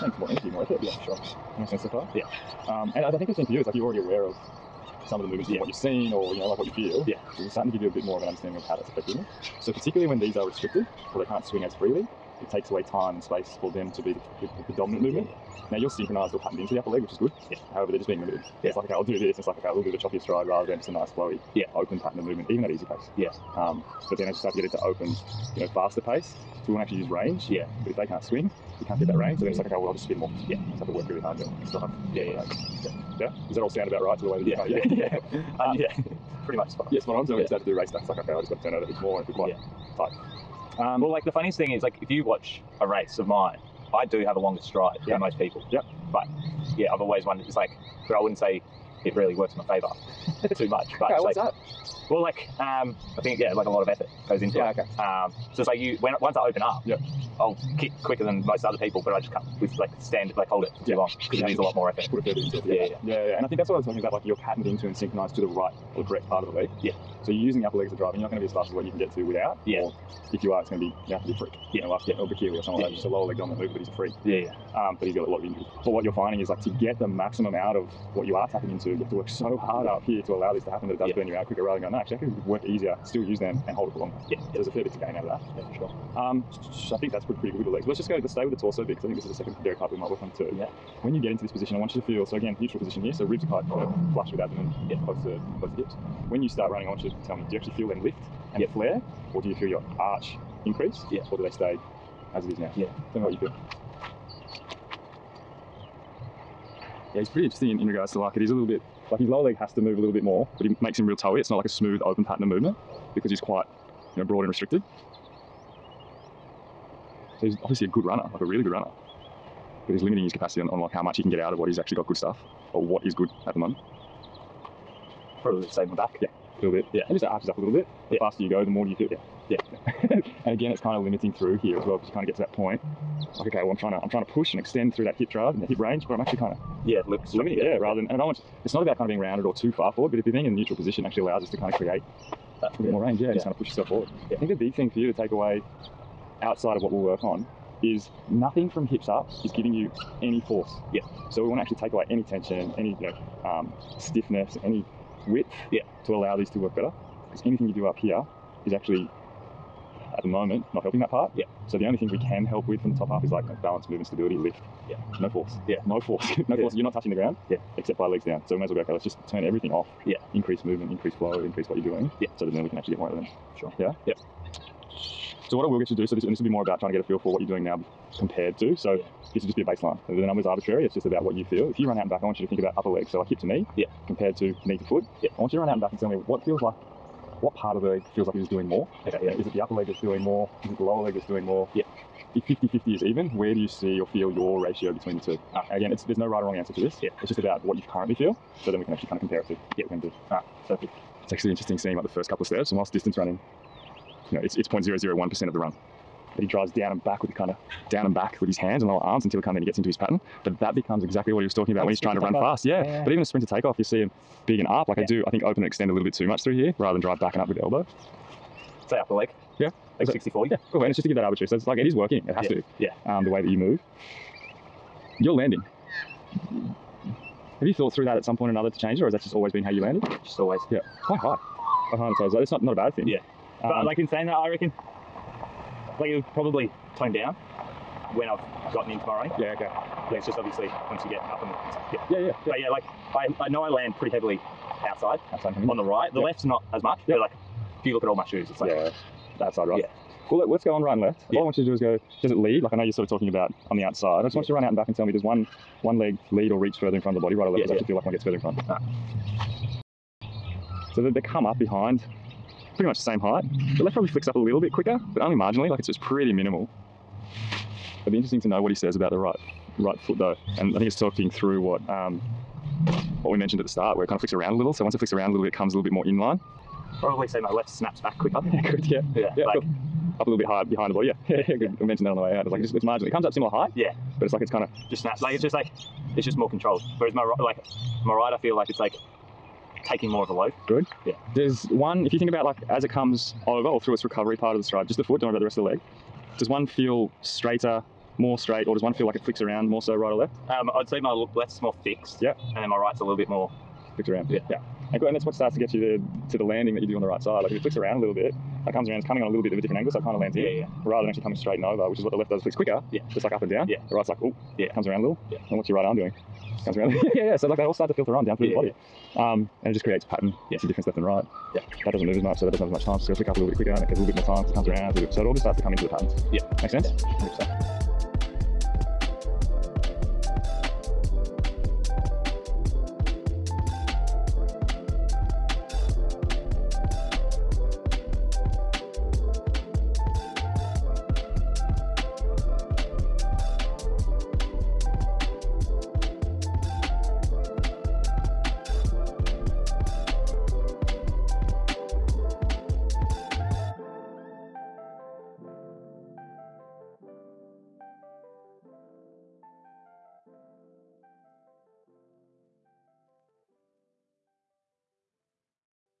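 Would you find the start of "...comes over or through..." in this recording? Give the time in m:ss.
4:52.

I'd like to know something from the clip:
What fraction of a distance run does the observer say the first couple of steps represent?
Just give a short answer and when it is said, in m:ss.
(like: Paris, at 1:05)
0.001%, at 3:24.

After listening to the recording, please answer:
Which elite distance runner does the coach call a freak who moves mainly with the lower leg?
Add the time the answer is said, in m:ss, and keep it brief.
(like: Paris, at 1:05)
Bekele, at 1:12.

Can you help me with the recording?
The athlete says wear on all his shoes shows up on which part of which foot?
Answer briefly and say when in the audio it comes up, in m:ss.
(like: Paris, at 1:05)
The outside right, at 4:09.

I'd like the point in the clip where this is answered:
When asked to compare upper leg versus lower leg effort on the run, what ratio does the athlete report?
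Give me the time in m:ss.
3:40.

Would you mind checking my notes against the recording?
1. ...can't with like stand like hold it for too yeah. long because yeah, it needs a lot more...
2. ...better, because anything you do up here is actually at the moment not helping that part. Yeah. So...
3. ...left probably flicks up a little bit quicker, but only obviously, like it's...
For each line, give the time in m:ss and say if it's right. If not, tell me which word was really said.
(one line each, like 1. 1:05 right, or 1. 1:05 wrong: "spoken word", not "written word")
1. 0:59 right
2. 2:36 right
3. 4:23 wrong: "marginally", not "obviously".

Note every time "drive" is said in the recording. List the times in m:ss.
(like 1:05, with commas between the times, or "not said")
0:31, 1:07, 2:15, 3:26, 3:37.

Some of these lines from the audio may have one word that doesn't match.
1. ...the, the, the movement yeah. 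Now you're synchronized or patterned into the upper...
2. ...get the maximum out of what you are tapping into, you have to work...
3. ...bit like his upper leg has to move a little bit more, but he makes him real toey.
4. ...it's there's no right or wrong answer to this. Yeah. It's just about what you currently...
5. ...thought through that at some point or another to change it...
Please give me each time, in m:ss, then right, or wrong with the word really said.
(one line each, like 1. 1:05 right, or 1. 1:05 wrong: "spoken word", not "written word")
1. 0:14 right
2. 1:16 right
3. 1:48 wrong: "lower", not "upper"
4. 3:15 right
5. 3:47 right.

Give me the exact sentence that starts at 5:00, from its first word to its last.
Um, I'd say my left's more fixed.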